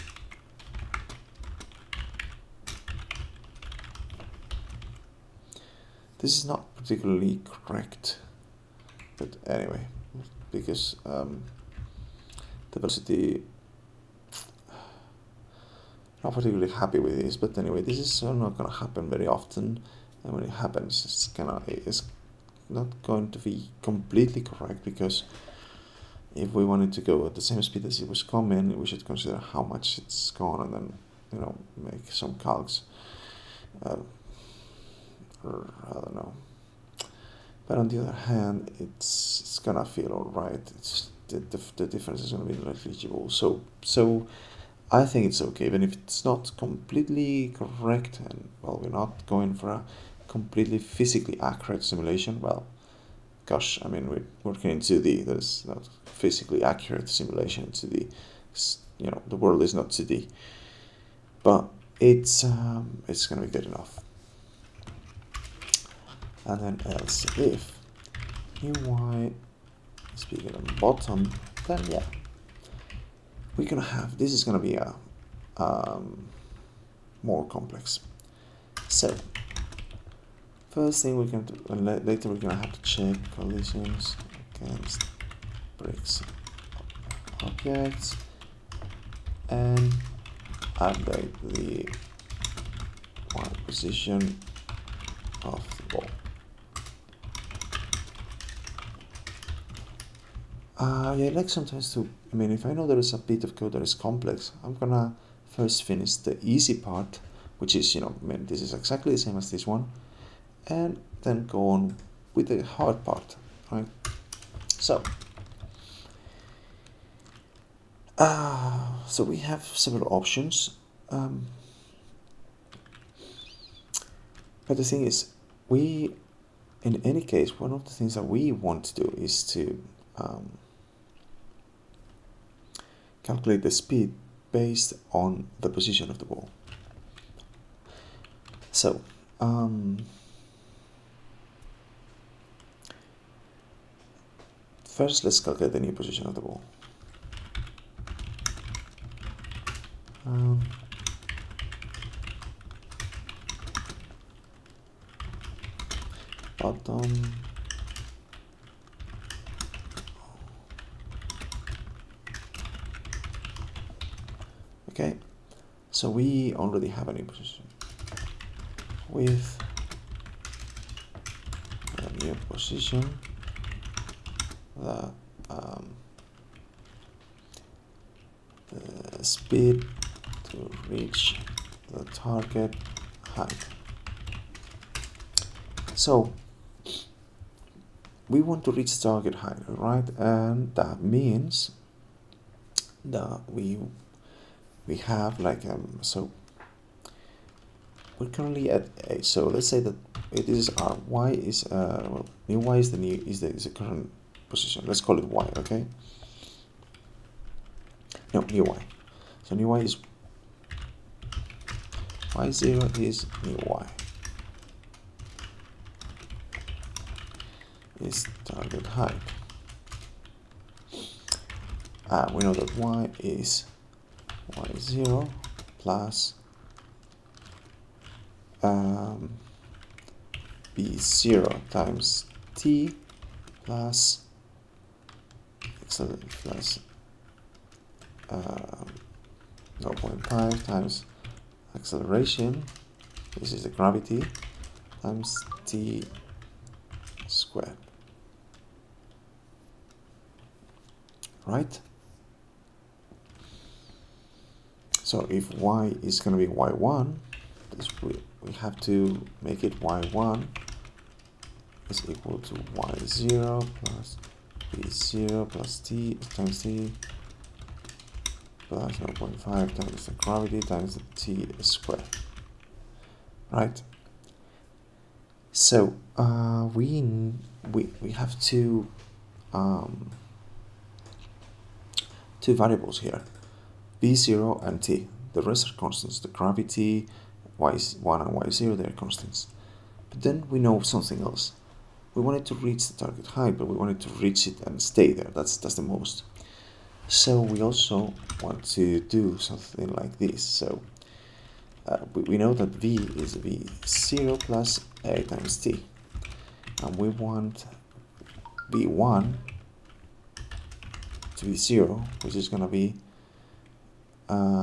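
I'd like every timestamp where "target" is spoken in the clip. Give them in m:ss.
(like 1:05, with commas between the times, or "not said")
3:02, 3:09, 3:38, 4:52.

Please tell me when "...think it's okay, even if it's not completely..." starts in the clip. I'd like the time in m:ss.
0:45.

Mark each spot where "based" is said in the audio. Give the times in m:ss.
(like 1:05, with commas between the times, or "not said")
2:14.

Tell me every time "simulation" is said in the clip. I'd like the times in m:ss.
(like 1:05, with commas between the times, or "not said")
0:51, 0:57.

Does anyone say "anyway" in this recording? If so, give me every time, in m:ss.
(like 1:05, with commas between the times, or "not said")
0:09, 0:17.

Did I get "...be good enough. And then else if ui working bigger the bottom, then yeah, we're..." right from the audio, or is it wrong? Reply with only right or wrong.
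wrong.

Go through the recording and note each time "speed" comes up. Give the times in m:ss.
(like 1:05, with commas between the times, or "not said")
0:27, 2:13, 2:59.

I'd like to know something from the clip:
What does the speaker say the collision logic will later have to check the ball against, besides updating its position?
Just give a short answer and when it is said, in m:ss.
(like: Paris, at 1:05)
bricks, at 1:25.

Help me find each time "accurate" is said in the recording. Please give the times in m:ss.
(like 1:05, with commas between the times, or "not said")
0:51, 0:56.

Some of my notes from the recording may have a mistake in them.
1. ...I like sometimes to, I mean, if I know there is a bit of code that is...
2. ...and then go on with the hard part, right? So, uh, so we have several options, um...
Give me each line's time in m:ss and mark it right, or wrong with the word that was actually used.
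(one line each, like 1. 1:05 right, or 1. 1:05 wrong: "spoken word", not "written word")
1. 1:41 right
2. 1:50 right.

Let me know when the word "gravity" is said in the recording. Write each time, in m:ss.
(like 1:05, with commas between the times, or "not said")
4:03, 4:30, 4:46.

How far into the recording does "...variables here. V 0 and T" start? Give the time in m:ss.
4:42.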